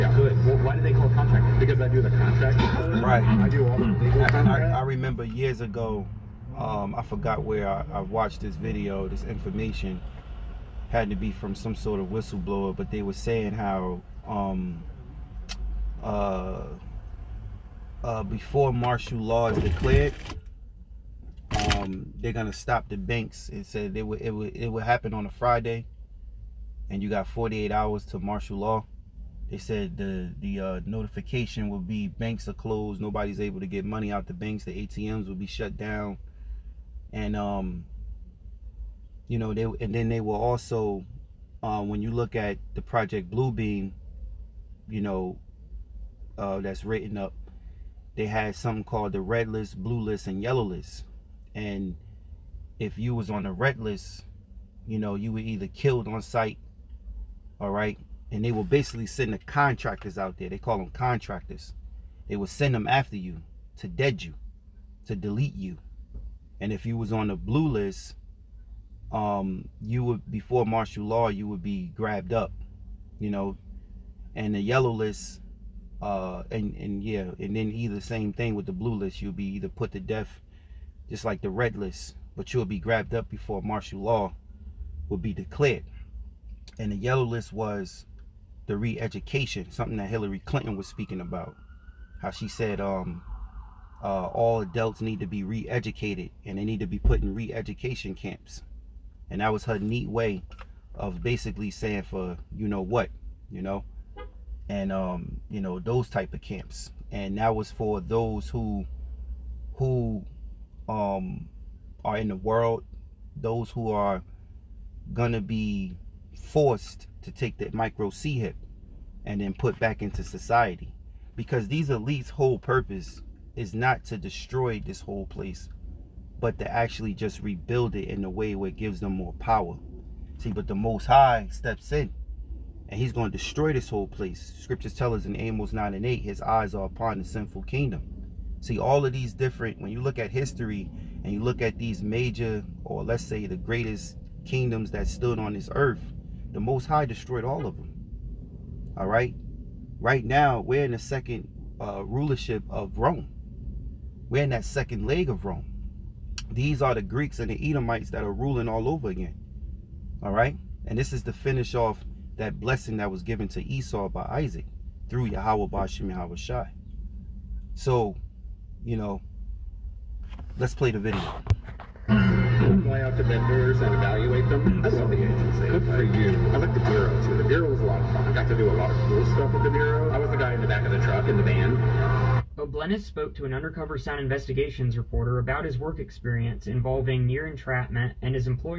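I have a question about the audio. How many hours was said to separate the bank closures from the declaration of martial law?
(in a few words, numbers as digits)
48.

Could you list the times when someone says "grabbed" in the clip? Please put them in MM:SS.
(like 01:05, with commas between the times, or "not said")
01:11, 01:22.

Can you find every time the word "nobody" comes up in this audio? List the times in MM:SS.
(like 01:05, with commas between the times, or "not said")
00:32.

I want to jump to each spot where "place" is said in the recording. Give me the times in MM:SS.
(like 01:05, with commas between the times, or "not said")
02:05, 02:14.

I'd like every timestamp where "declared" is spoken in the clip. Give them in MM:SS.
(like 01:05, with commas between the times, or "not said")
00:19, 01:25.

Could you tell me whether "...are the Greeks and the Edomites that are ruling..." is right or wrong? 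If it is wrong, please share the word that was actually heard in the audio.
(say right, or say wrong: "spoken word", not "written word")
right.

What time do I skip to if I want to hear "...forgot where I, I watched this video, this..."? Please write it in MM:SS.
00:07.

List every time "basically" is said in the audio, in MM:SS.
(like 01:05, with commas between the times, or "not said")
00:58, 01:41.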